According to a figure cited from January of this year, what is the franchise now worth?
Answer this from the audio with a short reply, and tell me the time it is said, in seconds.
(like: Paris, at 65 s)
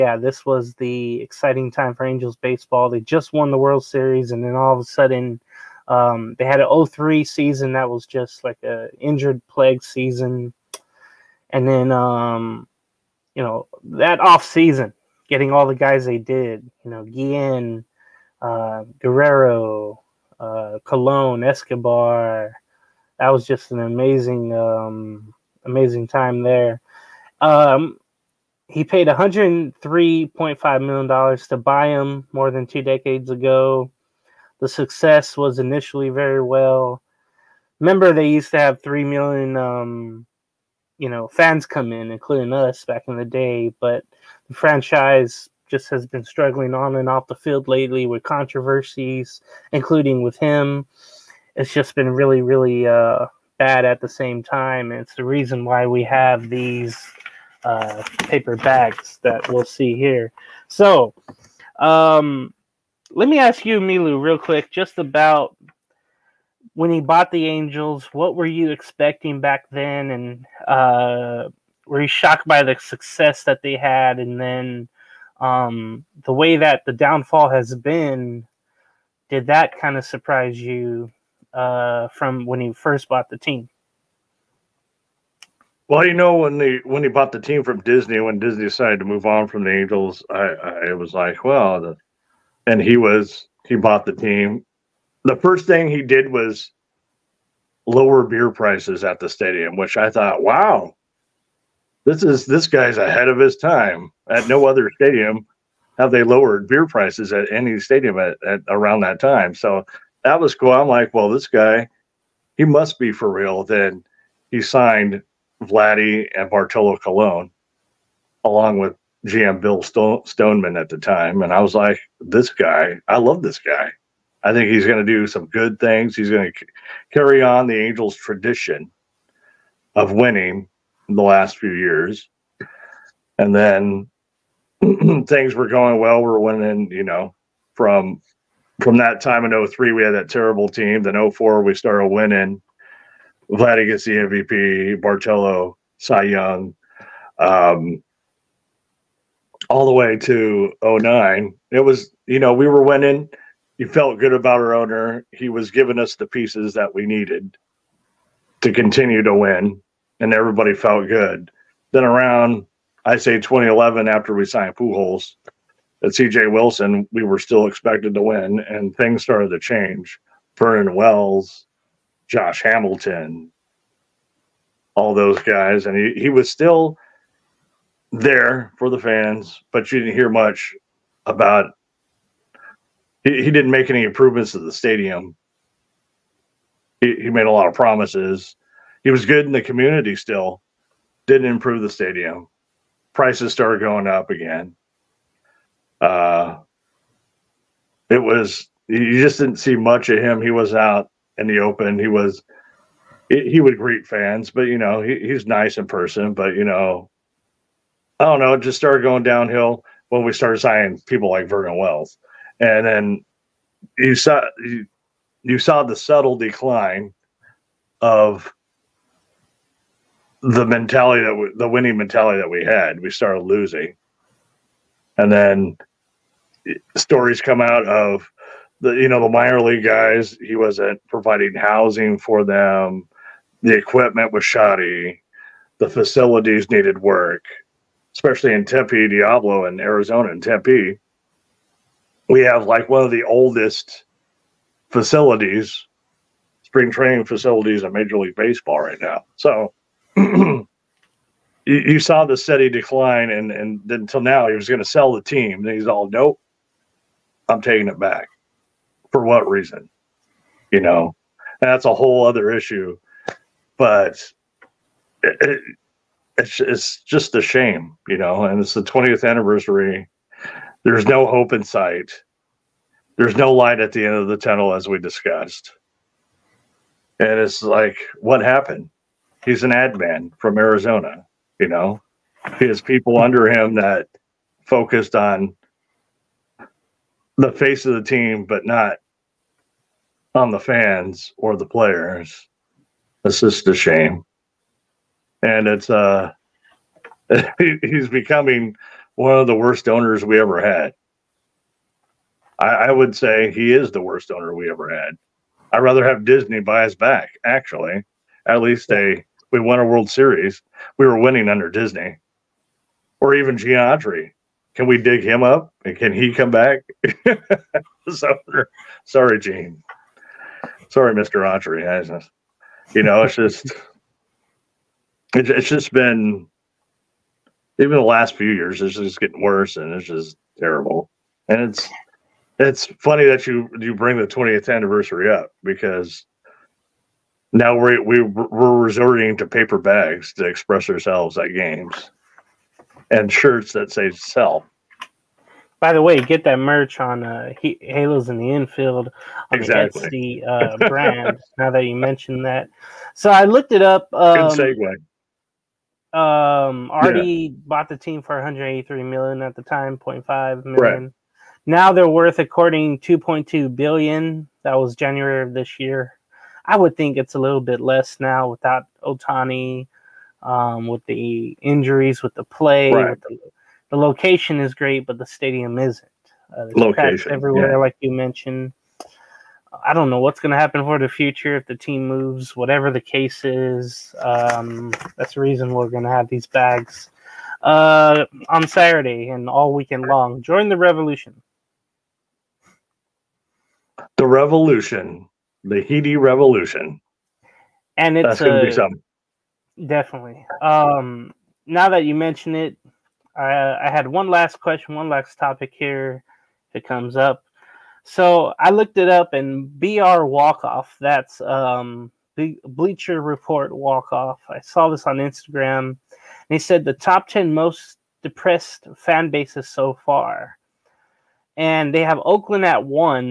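2.2 billion, at 362 s.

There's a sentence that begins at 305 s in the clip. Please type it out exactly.
I'd rather have Disney buy us back, actually.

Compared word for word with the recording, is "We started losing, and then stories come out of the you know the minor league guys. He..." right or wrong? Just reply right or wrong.
right.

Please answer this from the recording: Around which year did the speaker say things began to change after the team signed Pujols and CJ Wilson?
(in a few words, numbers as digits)
2011.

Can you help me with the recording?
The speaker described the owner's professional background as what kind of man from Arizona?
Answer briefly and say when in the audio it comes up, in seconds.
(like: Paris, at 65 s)
Ad man, at 279 s.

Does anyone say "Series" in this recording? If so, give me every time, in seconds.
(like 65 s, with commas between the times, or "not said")
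3 s, 310 s.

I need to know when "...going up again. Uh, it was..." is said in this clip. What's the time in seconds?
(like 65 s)
193 s.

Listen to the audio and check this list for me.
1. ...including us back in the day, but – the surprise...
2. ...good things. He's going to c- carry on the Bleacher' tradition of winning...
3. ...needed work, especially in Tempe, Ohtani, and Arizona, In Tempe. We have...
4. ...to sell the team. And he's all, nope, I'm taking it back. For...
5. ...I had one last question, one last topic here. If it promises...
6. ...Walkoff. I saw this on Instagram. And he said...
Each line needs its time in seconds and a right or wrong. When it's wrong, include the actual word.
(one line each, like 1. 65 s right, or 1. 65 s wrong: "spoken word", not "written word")
1. 42 s wrong: "franchise", not "surprise"
2. 125 s wrong: "Angels", not "Bleacher"
3. 236 s wrong: "Diablo", not "Ohtani"
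4. 254 s right
5. 403 s wrong: "comes", not "promises"
6. 413 s right.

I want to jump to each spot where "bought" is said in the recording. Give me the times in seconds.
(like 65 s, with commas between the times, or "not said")
67 s, 83 s, 87 s, 93 s, 357 s.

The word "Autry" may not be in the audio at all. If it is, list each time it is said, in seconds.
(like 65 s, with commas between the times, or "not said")
313 s, 321 s.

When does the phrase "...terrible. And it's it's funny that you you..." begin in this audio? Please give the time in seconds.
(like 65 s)
330 s.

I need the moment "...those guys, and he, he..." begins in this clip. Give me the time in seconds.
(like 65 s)
175 s.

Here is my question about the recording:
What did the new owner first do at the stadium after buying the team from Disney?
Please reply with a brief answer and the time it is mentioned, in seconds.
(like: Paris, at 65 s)
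Lower beer prices, at 97 s.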